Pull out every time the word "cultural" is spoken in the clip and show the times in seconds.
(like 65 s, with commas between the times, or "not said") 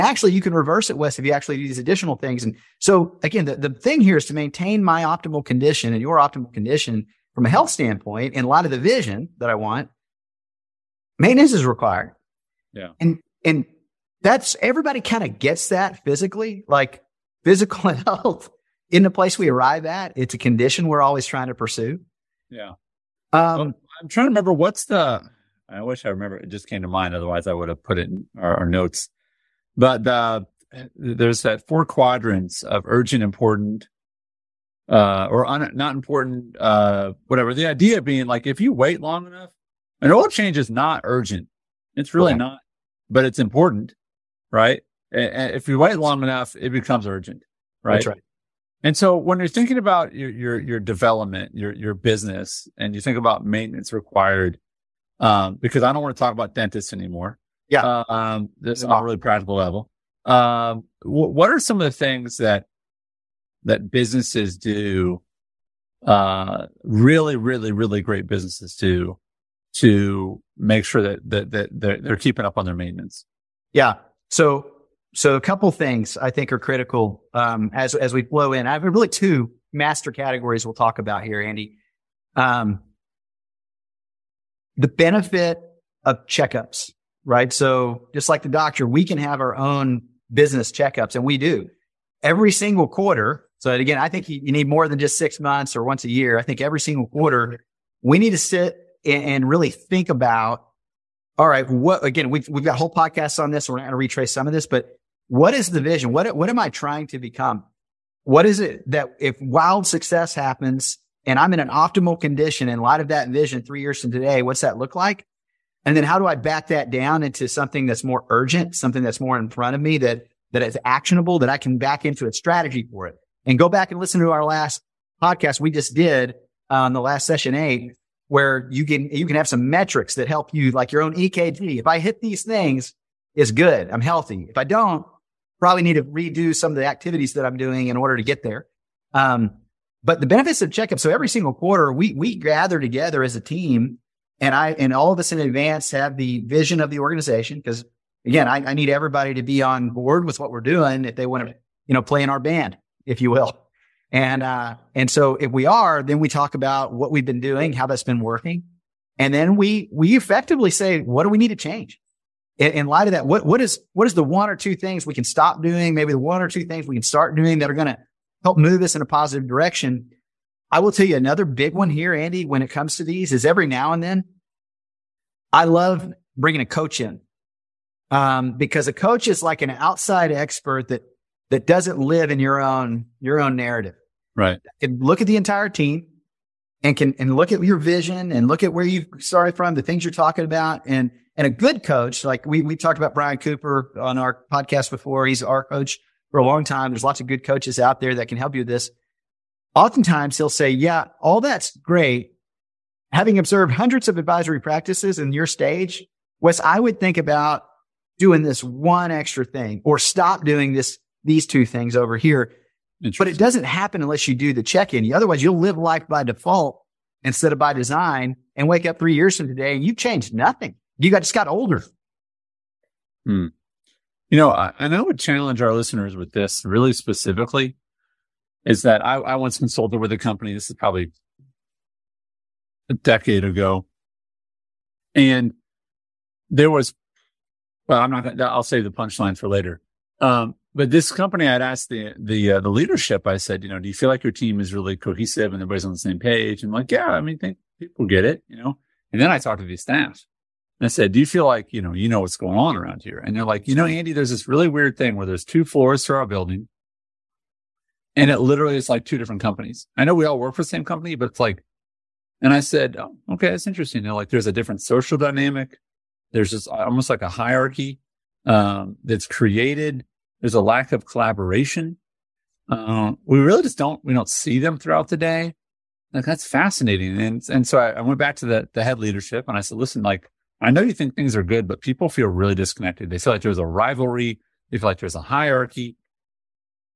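not said.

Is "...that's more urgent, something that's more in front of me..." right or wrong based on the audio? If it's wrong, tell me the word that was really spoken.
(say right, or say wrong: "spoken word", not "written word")
right.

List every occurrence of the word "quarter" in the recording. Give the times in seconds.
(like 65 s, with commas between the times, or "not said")
92 s, 97 s, 141 s.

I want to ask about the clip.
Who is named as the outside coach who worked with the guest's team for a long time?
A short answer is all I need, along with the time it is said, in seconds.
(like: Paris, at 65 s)
Brian Cooper, at 193 s.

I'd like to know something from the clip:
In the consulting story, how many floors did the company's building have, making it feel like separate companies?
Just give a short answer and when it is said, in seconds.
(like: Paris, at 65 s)
2, at 255 s.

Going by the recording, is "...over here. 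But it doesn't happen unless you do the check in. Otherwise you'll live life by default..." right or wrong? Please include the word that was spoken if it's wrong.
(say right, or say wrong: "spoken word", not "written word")
right.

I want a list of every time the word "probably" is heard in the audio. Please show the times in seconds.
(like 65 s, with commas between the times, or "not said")
135 s, 230 s.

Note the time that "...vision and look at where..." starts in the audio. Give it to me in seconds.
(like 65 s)
187 s.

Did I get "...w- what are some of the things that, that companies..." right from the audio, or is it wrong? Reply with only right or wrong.
wrong.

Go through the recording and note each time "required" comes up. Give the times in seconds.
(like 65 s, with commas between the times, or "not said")
11 s, 53 s.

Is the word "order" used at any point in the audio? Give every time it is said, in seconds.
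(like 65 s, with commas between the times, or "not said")
137 s.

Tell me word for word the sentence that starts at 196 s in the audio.
There's lots of good coaches out there that can help you with this.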